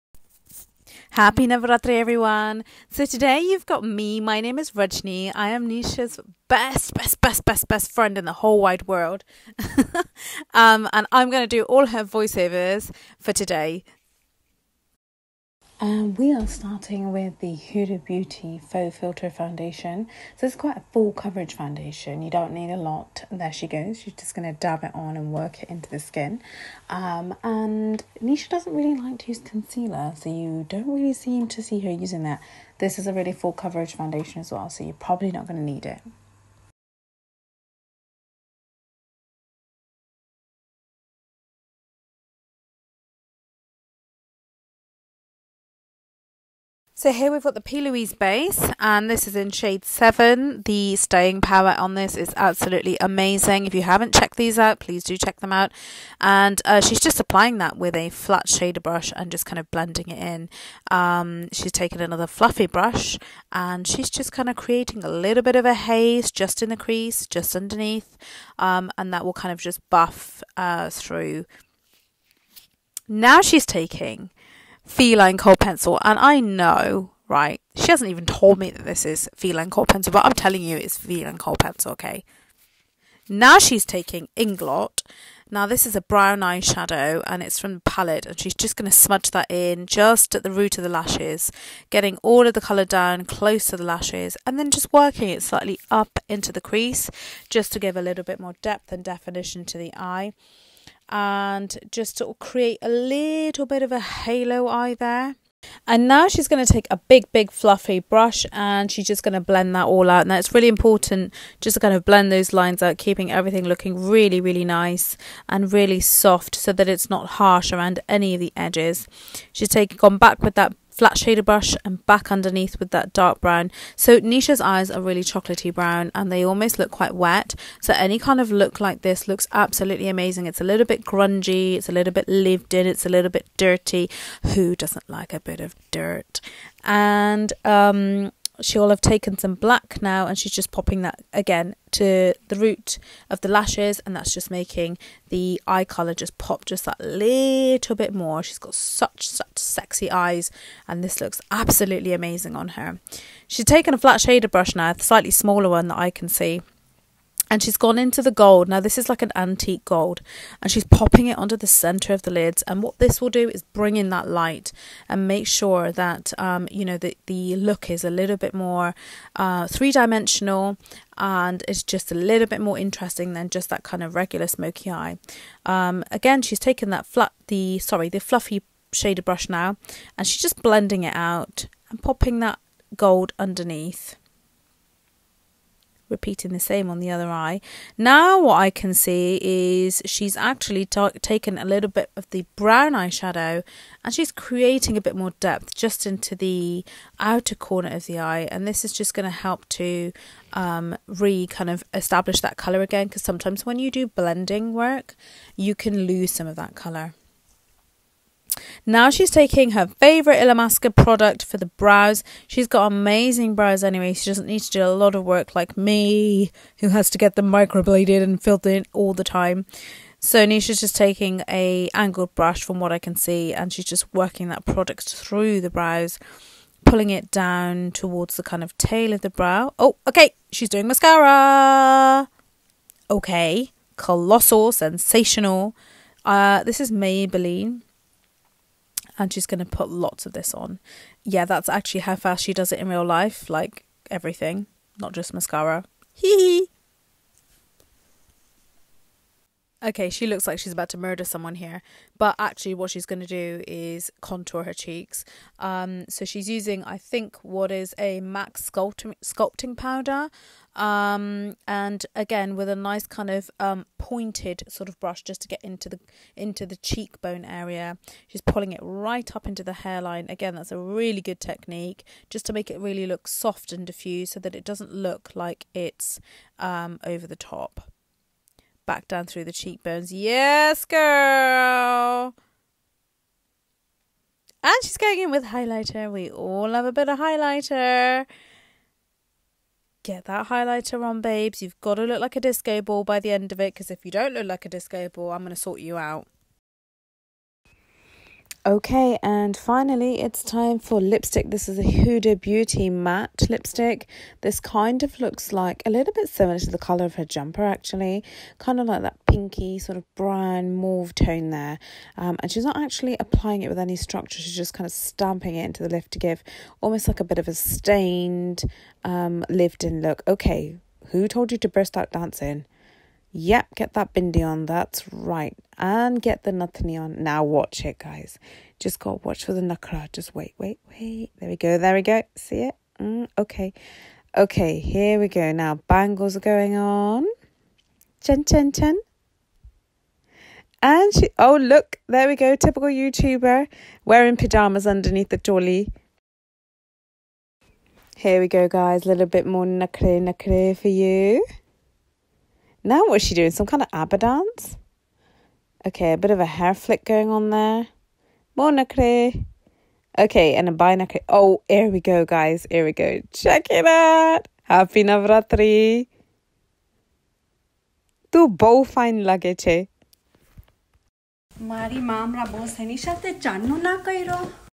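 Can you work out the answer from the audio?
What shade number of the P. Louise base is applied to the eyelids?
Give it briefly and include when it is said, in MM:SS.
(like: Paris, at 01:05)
7, at 00:49.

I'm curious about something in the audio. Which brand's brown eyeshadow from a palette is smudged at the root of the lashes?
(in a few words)
Inglot.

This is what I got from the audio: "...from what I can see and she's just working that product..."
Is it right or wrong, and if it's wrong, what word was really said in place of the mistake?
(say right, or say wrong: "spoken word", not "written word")
right.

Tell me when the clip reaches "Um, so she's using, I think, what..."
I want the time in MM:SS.
04:15.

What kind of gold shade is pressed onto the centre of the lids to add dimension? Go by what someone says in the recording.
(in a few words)
Antique gold.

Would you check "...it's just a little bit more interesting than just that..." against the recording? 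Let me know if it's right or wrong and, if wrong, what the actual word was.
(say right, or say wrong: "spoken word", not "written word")
right.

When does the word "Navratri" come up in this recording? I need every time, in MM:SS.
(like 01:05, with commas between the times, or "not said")
00:01, 06:05.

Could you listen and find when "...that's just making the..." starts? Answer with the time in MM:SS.
02:24.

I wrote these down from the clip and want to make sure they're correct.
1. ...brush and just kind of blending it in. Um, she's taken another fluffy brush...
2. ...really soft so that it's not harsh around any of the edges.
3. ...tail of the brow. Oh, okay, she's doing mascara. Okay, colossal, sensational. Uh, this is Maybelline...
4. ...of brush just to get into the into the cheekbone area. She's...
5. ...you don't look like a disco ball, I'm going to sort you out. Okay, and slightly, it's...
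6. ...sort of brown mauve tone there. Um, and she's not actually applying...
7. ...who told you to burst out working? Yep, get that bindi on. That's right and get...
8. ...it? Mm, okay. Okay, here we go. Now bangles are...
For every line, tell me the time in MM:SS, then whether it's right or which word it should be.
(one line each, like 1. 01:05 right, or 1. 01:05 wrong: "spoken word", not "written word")
1. 00:58 right
2. 01:55 right
3. 03:48 right
4. 04:24 right
5. 04:54 wrong: "finally", not "slightly"
6. 05:09 right
7. 05:21 wrong: "dancing", not "working"
8. 05:32 right.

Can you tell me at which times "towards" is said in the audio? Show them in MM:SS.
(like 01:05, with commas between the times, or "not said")
03:47.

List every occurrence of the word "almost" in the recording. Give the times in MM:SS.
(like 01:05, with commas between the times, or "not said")
02:06, 05:16.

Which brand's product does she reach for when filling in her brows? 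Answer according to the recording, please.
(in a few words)
Illamasqua.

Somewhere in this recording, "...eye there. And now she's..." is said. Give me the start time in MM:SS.
01:44.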